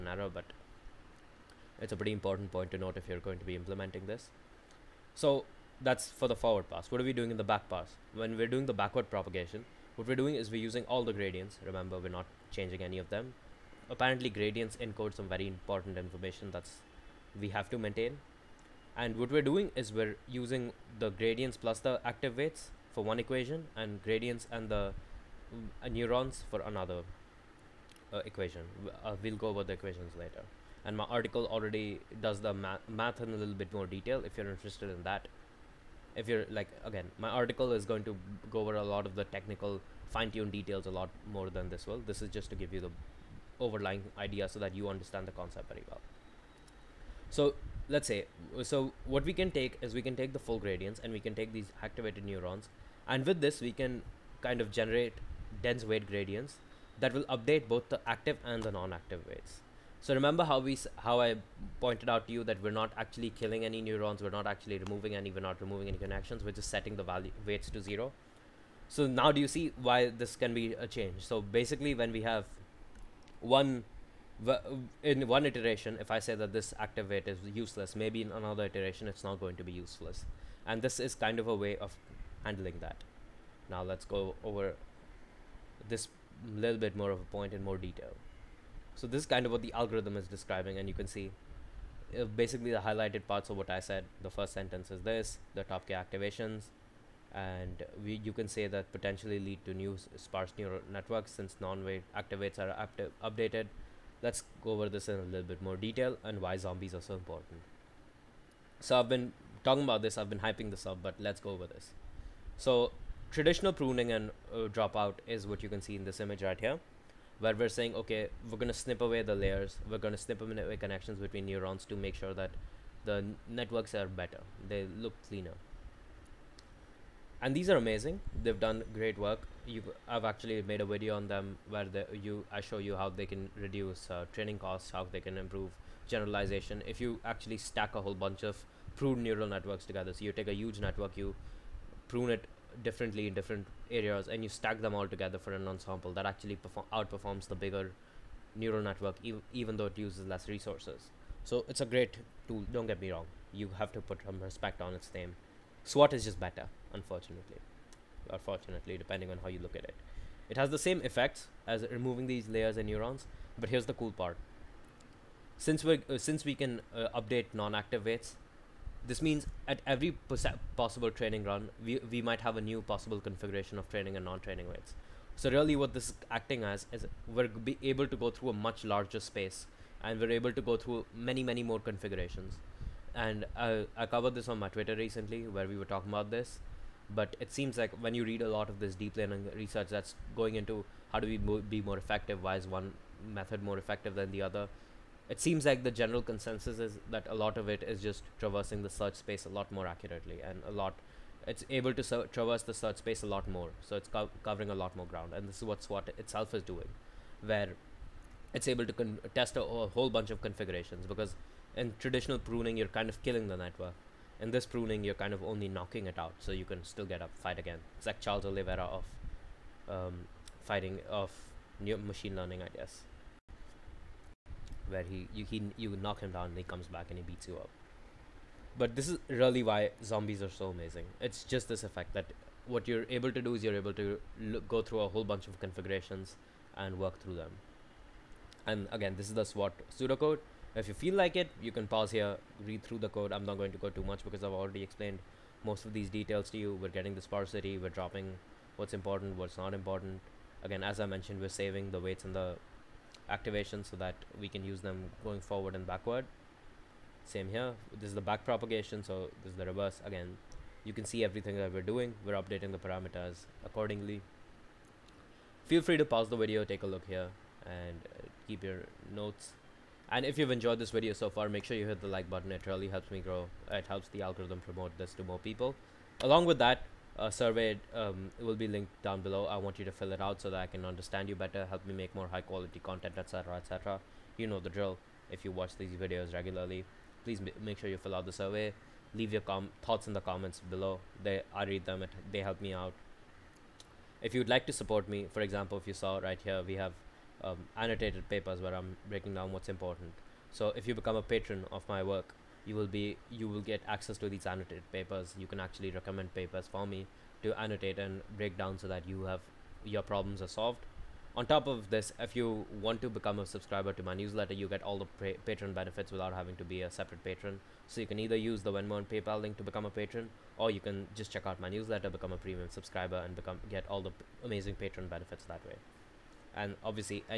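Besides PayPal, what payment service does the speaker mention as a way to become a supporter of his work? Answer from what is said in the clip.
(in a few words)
Venmo.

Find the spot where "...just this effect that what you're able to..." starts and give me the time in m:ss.
3:51.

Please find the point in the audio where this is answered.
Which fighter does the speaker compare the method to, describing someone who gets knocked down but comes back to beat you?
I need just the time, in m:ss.
3:38.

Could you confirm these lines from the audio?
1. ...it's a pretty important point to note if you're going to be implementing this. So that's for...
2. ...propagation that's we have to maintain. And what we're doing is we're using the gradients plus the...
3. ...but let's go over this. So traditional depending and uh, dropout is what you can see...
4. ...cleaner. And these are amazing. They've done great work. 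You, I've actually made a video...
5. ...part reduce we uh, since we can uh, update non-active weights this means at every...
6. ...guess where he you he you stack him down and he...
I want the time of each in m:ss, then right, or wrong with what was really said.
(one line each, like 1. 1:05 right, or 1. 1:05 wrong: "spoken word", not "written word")
1. 0:01 right
2. 0:15 wrong: "information", not "propagation"
3. 1:51 wrong: "pruning", not "depending"
4. 2:05 right
5. 2:44 wrong: "since", not "reduce"
6. 3:42 wrong: "knock", not "stack".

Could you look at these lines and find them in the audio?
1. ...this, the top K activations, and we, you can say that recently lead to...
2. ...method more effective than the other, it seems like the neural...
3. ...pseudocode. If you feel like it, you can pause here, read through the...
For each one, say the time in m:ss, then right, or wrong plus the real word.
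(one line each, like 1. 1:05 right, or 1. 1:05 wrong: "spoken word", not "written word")
1. 1:35 wrong: "potentially", not "recently"
2. 3:13 wrong: "general", not "neural"
3. 3:59 right.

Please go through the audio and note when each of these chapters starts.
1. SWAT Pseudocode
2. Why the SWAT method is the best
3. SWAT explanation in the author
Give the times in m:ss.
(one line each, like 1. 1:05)
1. 3:46
2. 1:46
3. 1:26.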